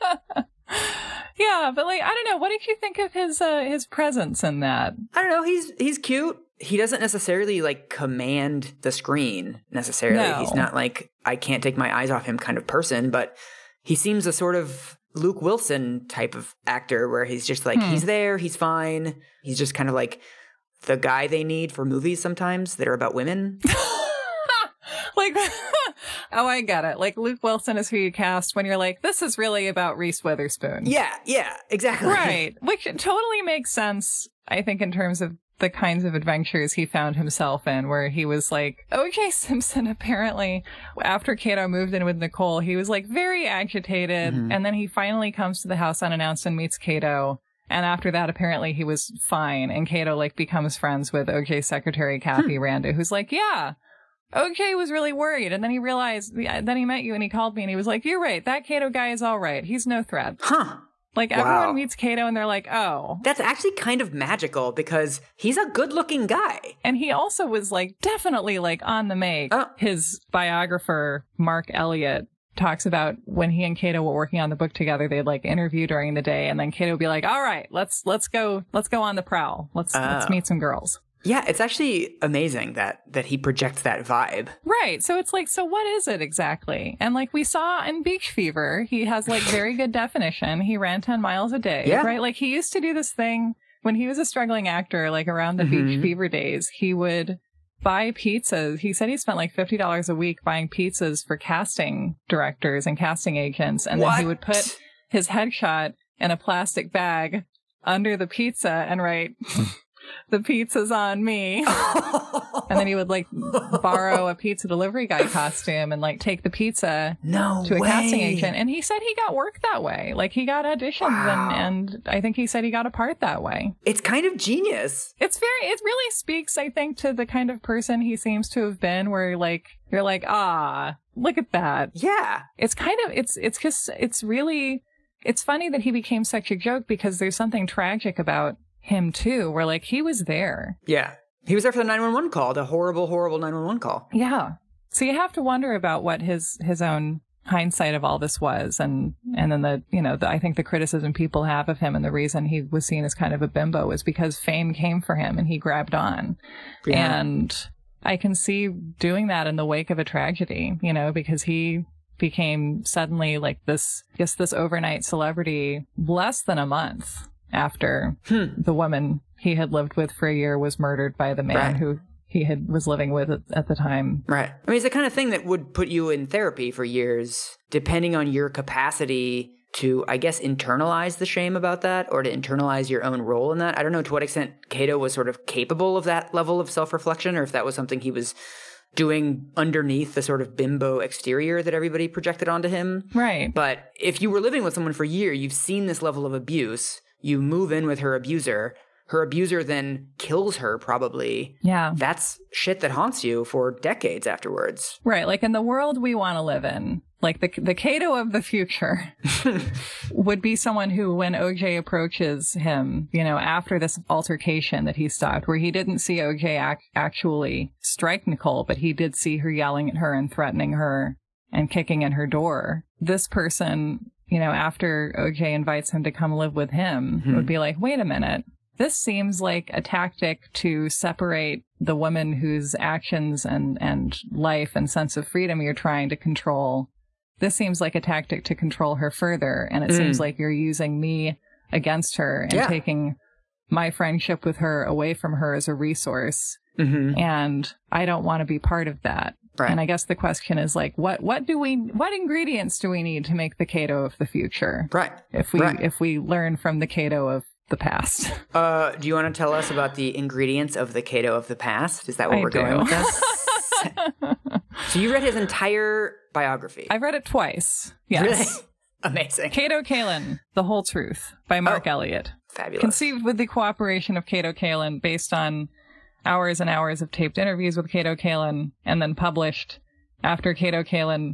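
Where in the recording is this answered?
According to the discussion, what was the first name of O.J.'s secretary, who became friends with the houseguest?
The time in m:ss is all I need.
0:52.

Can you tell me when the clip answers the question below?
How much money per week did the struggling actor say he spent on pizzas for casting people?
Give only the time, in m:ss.
1:39.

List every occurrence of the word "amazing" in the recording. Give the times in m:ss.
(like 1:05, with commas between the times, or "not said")
1:22, 4:29.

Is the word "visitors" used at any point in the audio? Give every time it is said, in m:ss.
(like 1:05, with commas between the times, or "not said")
not said.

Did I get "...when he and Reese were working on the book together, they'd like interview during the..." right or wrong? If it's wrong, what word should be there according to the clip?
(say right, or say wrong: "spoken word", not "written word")
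wrong: "Kato", not "Reese".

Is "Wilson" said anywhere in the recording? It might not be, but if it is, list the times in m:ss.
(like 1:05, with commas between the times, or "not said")
0:15, 0:27.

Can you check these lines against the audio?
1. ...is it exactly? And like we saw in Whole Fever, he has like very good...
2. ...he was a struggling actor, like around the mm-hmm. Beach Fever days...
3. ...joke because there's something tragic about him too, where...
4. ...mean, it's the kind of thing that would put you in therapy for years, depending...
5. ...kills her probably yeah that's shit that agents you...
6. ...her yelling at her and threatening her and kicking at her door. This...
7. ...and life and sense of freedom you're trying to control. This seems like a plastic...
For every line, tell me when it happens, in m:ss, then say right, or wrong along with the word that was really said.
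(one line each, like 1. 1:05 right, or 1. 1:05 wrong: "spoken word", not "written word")
1. 1:25 wrong: "Beach", not "Whole"
2. 1:33 right
3. 2:16 right
4. 2:54 right
5. 3:20 wrong: "haunts", not "agents"
6. 3:39 right
7. 3:53 wrong: "tactic", not "plastic".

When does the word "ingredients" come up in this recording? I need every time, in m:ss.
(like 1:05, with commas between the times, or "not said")
4:12, 4:20.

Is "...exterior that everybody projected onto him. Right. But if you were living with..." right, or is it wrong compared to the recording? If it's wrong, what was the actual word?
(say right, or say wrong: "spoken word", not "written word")
right.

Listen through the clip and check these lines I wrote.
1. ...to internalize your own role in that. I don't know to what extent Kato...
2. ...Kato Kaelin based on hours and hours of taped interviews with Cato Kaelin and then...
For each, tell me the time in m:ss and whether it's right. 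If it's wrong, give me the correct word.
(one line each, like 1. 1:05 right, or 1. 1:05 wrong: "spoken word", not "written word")
1. 3:02 right
2. 4:34 wrong: "Kalin", not "Kaelin".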